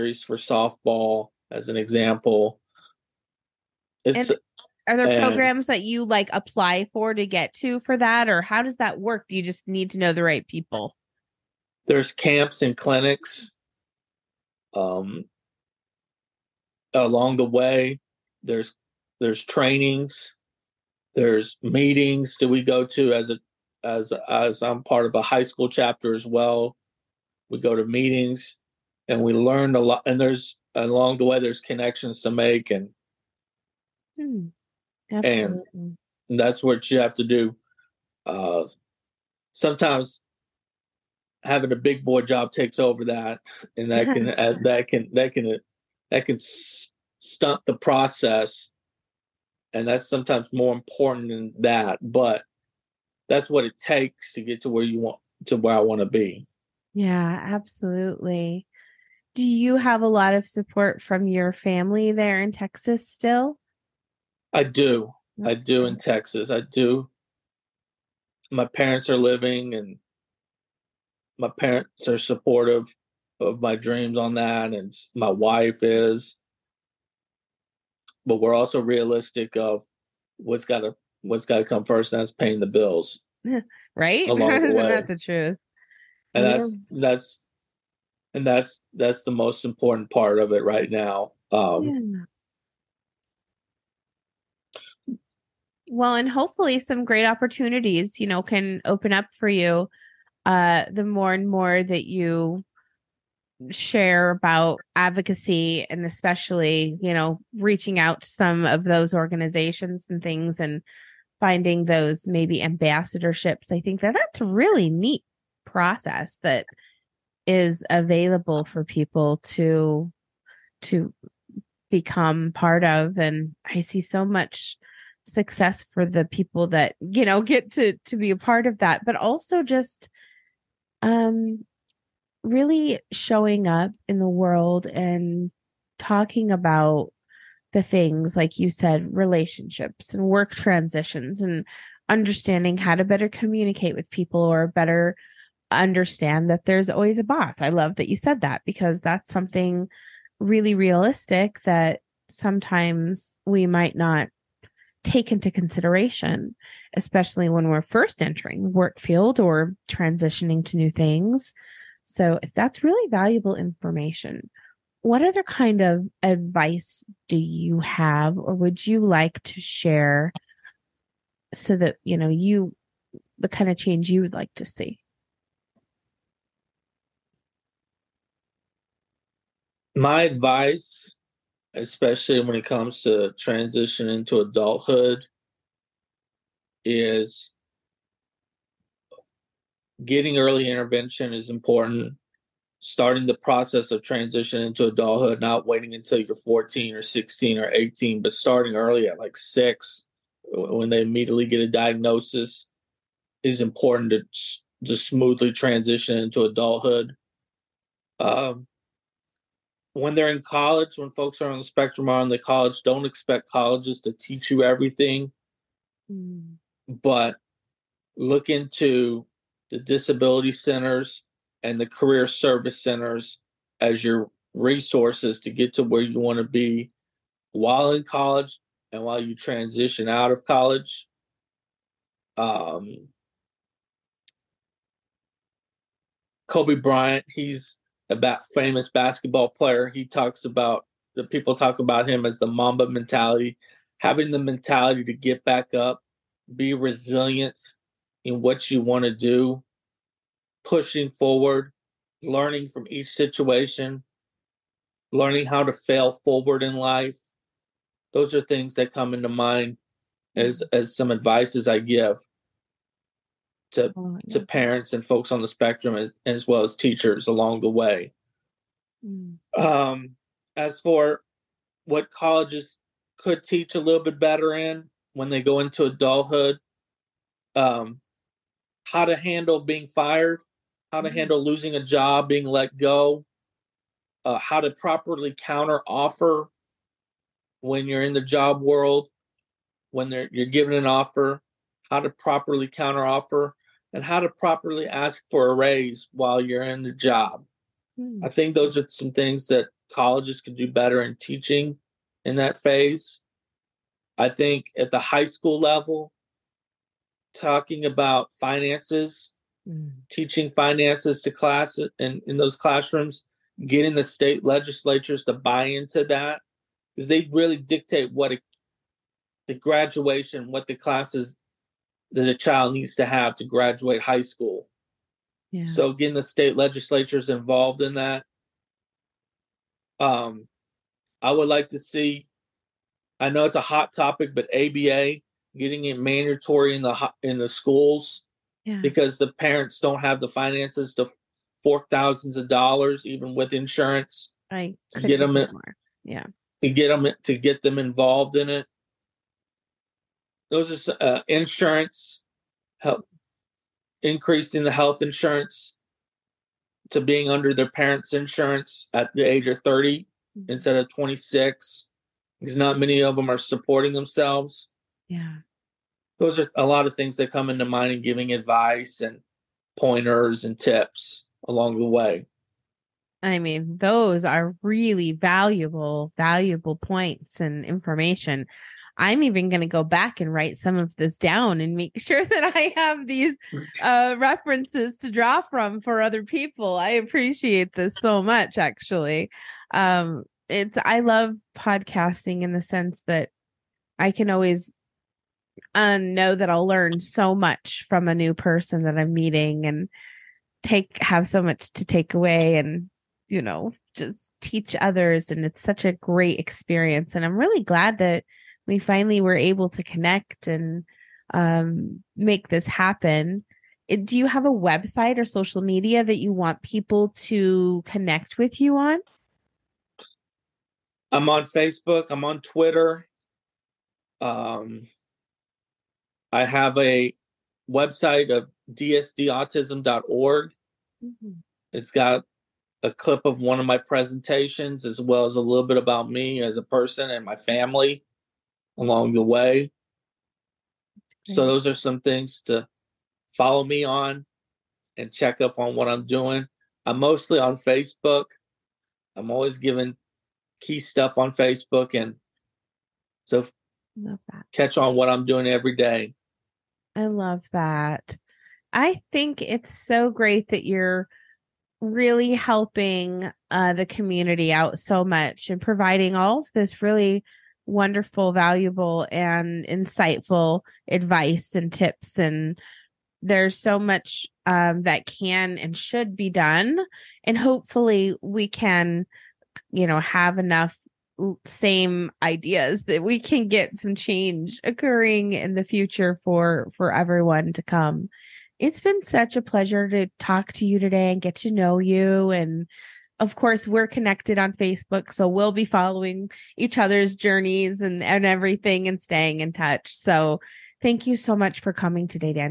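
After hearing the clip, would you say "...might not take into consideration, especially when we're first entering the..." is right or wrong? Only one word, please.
right.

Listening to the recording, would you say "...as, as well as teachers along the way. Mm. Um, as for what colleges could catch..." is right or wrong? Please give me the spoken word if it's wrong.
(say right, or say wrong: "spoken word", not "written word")
wrong: "teach", not "catch".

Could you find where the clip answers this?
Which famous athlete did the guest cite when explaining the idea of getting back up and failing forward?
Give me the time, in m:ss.
3:56.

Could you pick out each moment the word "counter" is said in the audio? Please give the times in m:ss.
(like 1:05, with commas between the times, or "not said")
4:45, 4:52.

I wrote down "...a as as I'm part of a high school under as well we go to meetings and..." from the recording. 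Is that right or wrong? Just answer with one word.
wrong.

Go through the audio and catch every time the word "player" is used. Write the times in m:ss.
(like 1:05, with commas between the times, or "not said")
3:59.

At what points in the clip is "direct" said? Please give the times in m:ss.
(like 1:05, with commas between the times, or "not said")
not said.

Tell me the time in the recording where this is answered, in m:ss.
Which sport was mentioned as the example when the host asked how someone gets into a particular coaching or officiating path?
0:00.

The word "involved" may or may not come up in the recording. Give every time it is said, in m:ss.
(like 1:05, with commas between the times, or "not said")
5:27, 5:47.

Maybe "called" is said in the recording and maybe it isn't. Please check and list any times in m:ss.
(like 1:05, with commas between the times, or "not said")
not said.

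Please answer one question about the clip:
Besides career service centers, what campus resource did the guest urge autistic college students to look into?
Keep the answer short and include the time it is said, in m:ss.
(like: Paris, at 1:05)
Disability centers, at 3:39.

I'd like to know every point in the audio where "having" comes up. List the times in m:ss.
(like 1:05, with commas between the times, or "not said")
0:41, 4:03.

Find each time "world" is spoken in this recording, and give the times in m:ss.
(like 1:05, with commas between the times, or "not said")
2:14, 4:48.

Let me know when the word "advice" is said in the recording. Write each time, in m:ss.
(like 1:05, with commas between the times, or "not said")
2:46, 3:00, 4:21, 6:08, 7:50.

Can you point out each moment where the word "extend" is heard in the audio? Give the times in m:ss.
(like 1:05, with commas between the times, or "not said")
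not said.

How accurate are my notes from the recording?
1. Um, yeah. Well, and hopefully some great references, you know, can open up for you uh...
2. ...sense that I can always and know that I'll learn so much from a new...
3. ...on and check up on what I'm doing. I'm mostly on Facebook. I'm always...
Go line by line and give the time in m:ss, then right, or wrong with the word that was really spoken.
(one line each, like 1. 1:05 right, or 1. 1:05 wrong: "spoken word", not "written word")
1. 1:31 wrong: "opportunities", not "references"
2. 6:32 right
3. 7:23 right.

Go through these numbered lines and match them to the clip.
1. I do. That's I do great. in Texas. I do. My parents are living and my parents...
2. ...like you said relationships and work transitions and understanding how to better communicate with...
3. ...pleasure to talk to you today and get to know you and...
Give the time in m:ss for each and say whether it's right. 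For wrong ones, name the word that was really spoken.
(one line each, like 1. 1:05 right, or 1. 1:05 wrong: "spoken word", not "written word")
1. 1:04 right
2. 2:18 right
3. 8:09 right.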